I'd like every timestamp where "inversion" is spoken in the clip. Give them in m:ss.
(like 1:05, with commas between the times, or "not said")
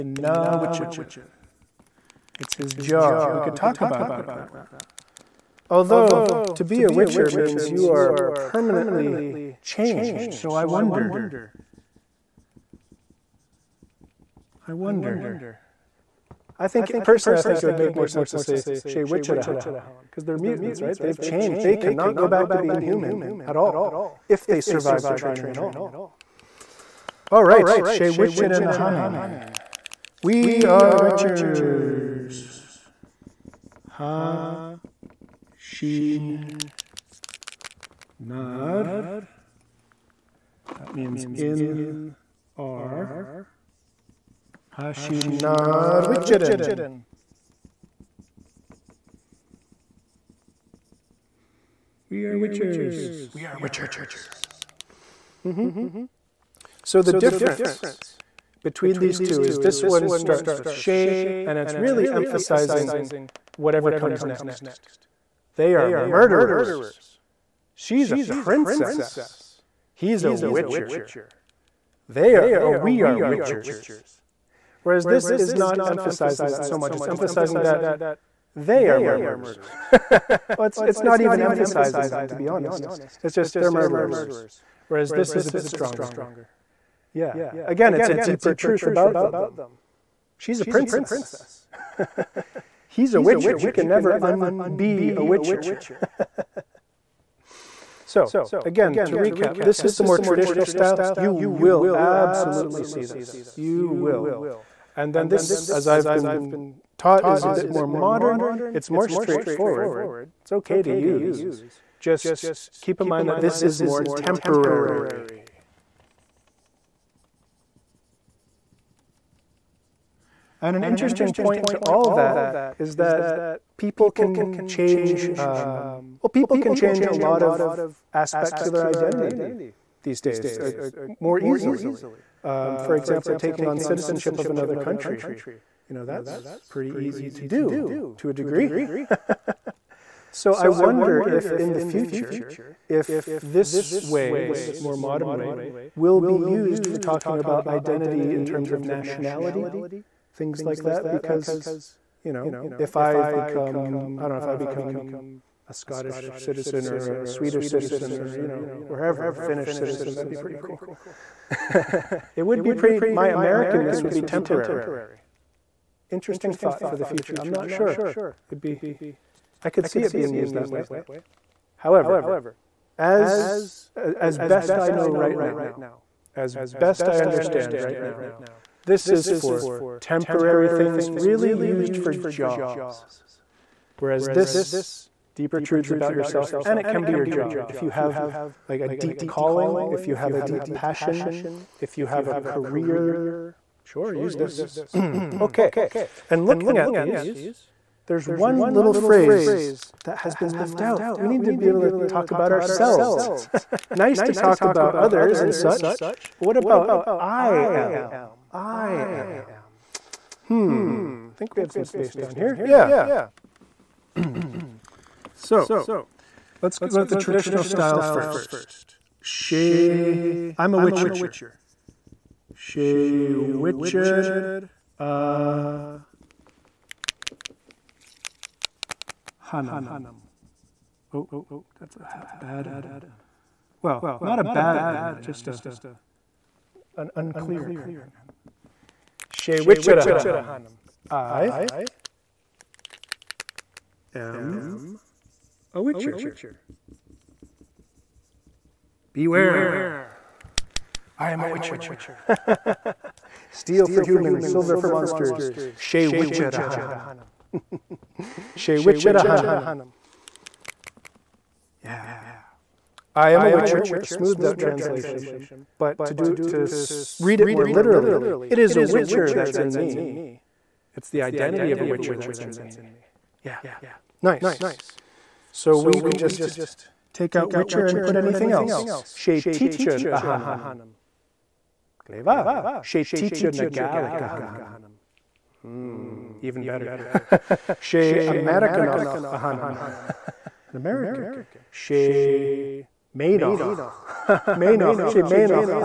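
not said.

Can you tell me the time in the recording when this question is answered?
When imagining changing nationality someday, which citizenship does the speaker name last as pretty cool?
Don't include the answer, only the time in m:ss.
2:39.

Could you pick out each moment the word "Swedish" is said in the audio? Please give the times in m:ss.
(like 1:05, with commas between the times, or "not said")
2:37.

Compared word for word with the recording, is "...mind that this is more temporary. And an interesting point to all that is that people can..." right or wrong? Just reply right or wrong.
right.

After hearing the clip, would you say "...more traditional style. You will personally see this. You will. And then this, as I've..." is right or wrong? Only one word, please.
wrong.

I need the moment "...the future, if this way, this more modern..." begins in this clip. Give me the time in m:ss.
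2:21.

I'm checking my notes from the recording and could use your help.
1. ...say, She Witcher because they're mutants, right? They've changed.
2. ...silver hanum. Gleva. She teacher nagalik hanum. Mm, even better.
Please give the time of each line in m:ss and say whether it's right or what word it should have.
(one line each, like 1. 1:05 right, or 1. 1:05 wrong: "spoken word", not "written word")
1. 0:18 right
2. 4:39 wrong: "teacher", not "silver".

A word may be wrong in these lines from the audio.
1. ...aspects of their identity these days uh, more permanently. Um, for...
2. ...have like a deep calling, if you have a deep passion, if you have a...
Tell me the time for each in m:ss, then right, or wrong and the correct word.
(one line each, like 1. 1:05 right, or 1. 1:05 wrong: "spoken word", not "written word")
1. 2:08 wrong: "easily", not "permanently"
2. 3:07 right.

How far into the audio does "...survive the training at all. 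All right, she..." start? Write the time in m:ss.
0:24.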